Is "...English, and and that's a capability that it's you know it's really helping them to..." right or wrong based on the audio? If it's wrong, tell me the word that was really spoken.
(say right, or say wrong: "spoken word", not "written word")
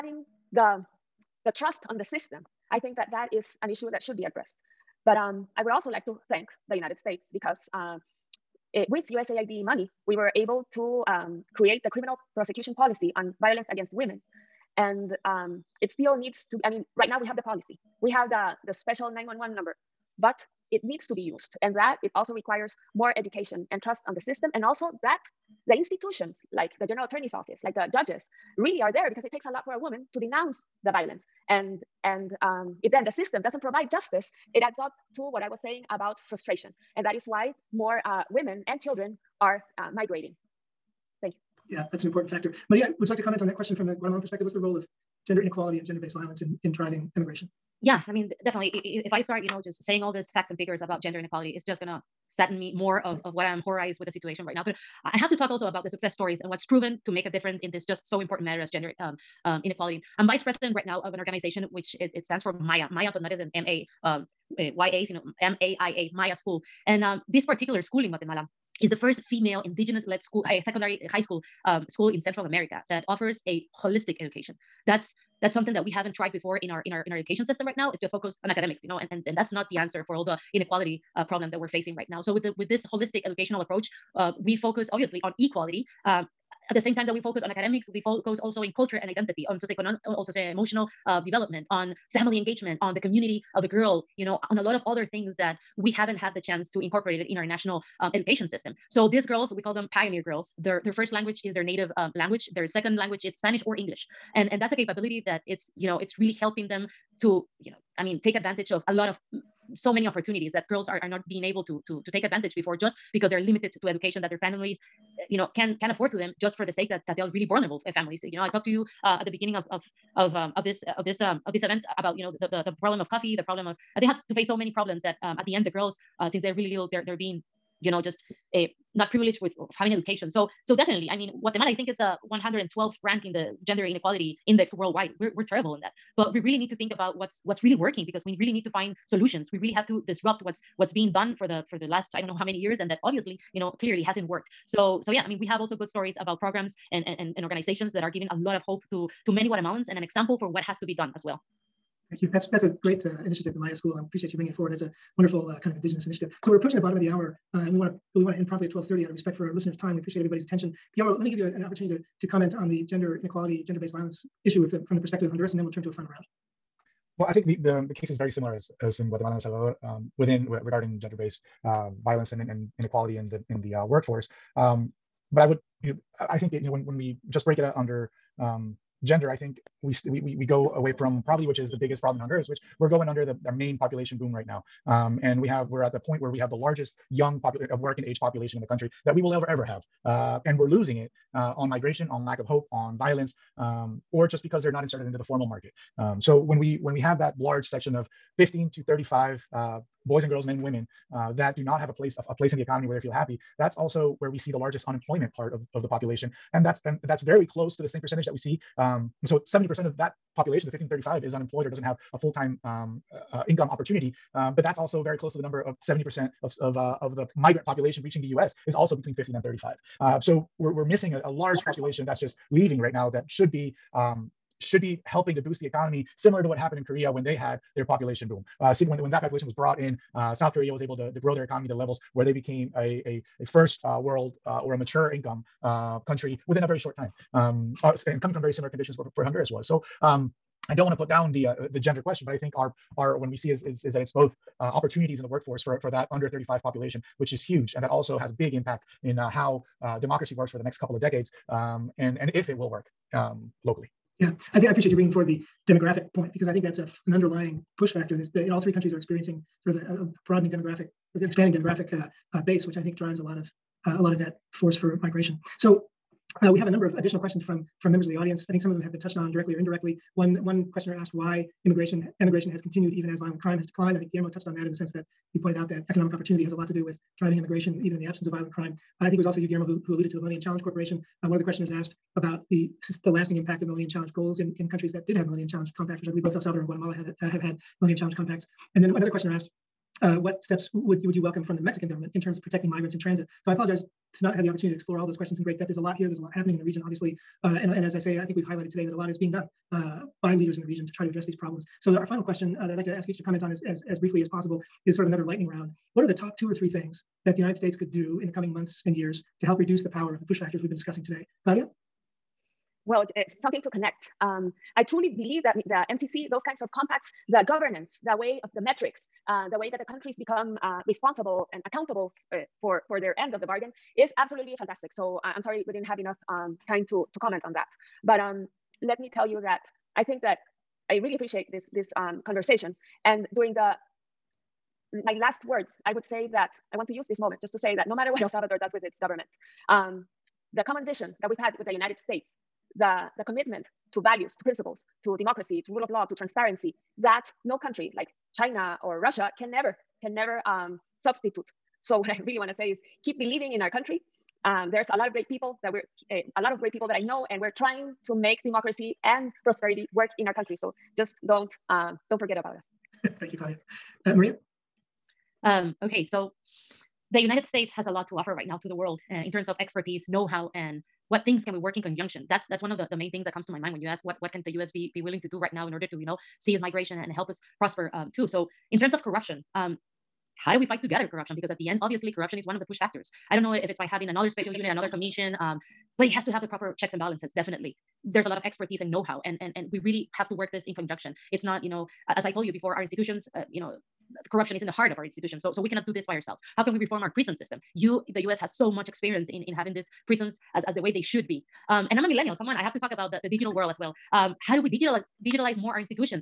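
right.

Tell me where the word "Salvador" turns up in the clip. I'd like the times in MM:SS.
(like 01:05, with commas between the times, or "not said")
02:49, 04:46, 05:38.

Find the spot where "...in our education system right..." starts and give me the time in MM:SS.
01:17.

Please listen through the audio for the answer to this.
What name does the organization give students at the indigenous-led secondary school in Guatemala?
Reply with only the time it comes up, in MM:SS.
01:39.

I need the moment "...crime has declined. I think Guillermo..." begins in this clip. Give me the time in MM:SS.
04:33.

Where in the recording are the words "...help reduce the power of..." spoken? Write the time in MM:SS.
05:09.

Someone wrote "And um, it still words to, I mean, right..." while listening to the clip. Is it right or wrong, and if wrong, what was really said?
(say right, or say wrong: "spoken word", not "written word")
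wrong: "needs", not "words".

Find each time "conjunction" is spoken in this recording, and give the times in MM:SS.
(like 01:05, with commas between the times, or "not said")
06:11, 06:30.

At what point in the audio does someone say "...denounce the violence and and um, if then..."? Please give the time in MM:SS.
00:30.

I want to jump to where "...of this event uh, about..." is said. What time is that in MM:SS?
02:01.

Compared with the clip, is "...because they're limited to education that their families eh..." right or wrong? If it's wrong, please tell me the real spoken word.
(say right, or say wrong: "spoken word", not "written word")
right.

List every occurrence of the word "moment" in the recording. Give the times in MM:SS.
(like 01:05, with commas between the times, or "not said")
05:37.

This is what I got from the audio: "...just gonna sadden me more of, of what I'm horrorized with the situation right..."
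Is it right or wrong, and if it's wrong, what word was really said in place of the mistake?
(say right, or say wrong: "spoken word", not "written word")
right.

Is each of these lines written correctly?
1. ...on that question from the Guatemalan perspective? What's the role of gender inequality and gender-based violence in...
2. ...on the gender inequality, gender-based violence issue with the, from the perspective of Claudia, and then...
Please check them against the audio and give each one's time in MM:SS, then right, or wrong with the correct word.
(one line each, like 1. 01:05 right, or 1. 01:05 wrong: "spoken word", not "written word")
1. 00:43 right
2. 02:42 wrong: "Honduras", not "Claudia".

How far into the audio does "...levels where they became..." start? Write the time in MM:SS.
03:51.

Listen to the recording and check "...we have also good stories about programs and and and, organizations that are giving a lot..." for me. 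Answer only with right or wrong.
right.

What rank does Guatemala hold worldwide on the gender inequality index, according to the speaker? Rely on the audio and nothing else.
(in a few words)
112th.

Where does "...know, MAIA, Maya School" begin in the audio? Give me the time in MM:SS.
01:05.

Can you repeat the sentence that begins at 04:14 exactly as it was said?
Yeah, I think I appreciate you bringing forward the demographic point because I think that's a, an underlying push factor.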